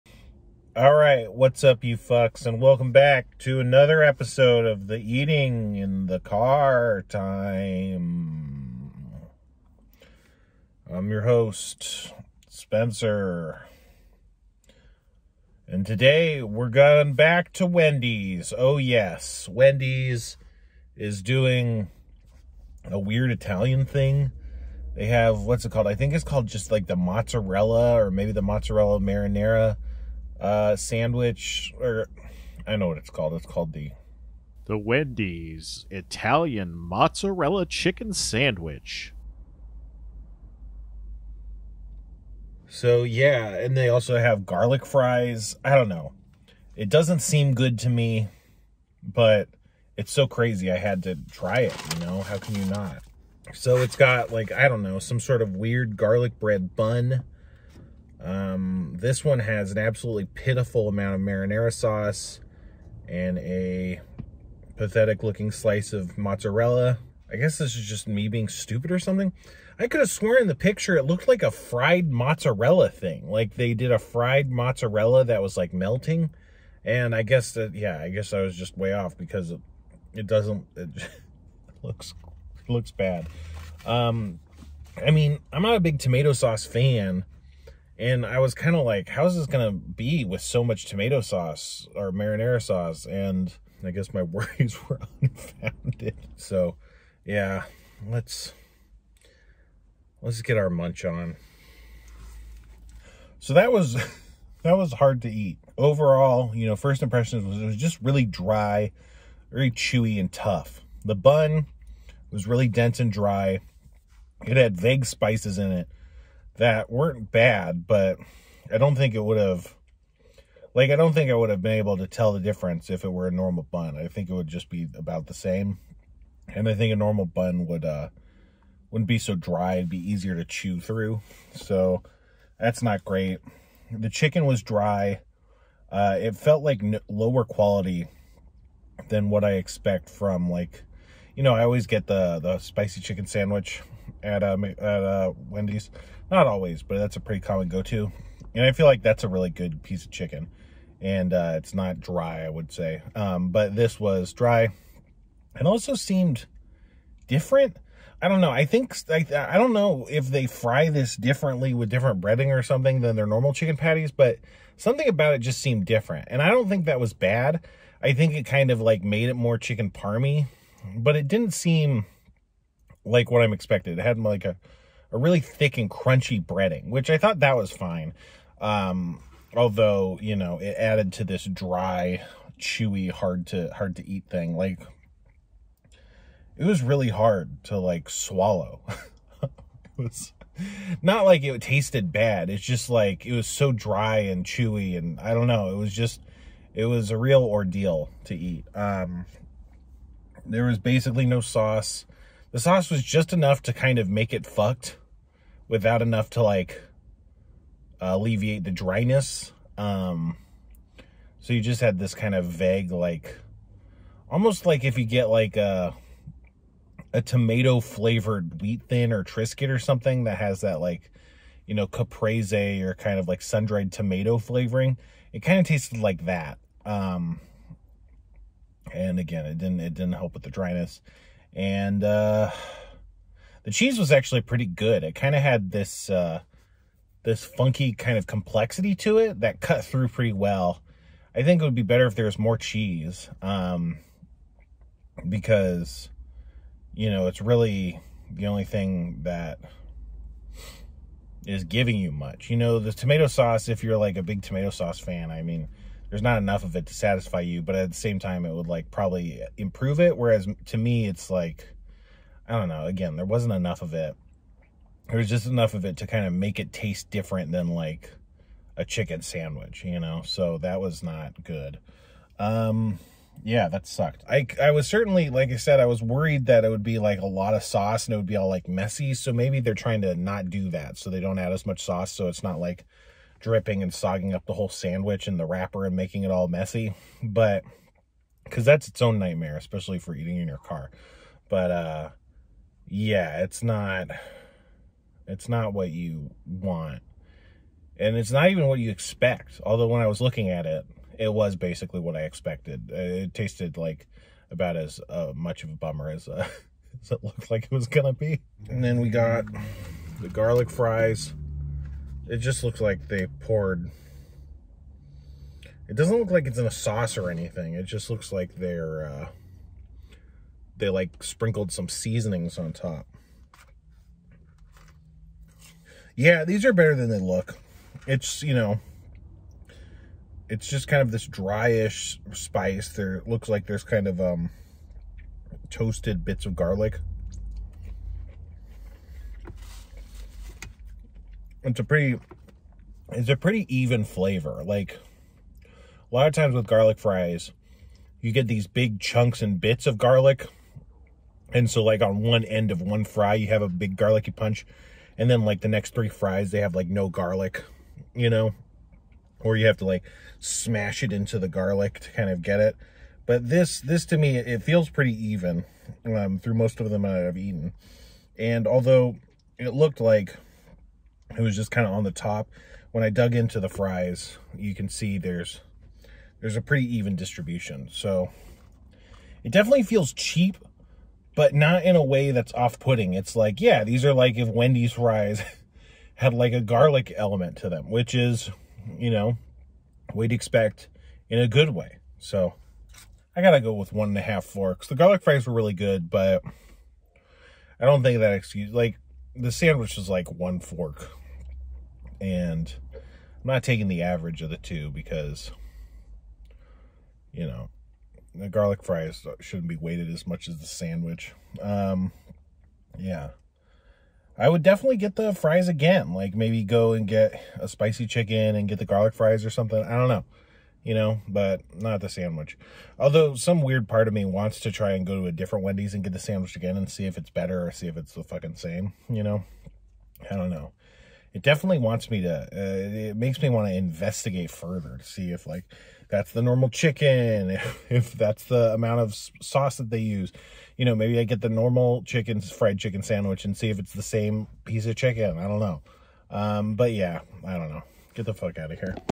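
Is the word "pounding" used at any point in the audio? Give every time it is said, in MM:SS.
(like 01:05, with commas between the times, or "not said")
not said.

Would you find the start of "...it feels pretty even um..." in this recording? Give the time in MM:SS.
06:04.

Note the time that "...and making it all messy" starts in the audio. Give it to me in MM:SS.
04:45.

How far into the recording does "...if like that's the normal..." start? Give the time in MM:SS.
07:15.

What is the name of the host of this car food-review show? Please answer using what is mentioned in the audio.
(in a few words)
Spencer.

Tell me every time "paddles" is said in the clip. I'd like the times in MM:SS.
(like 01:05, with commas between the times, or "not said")
not said.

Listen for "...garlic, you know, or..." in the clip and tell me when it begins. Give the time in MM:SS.
05:57.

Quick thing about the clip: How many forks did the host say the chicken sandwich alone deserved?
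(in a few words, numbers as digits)
1 fork.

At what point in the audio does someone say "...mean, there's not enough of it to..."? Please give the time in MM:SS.
04:15.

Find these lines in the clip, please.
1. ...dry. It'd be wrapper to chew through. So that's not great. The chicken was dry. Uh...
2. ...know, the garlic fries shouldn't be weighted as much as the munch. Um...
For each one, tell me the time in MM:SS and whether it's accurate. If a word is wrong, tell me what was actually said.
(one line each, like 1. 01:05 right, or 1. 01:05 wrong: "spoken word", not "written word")
1. 02:09 wrong: "easier", not "wrapper"
2. 06:47 wrong: "sandwich", not "munch".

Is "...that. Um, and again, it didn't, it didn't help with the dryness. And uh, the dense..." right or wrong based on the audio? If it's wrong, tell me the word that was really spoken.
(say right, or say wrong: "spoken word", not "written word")
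wrong: "cheese", not "dense".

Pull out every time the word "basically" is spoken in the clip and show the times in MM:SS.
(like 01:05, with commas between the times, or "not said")
03:20, 05:01.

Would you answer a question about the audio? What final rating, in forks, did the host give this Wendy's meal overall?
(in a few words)
1.5 forks.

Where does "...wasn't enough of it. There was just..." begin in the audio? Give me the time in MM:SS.
04:23.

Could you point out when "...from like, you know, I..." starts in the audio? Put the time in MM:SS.
02:20.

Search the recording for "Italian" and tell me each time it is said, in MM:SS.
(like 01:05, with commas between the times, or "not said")
00:23, 00:35.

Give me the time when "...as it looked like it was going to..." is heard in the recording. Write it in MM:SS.
05:07.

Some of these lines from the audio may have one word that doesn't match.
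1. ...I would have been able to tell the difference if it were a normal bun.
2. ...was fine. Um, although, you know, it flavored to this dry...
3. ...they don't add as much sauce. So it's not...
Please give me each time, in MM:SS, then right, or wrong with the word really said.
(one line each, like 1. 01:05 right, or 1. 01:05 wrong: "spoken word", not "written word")
1. 02:01 right
2. 02:57 wrong: "added", not "flavored"
3. 04:41 right.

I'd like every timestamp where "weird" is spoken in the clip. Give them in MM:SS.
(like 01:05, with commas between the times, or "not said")
00:22, 00:55, 07:03.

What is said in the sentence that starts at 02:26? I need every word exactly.
Not always, but that's a pretty common go-to.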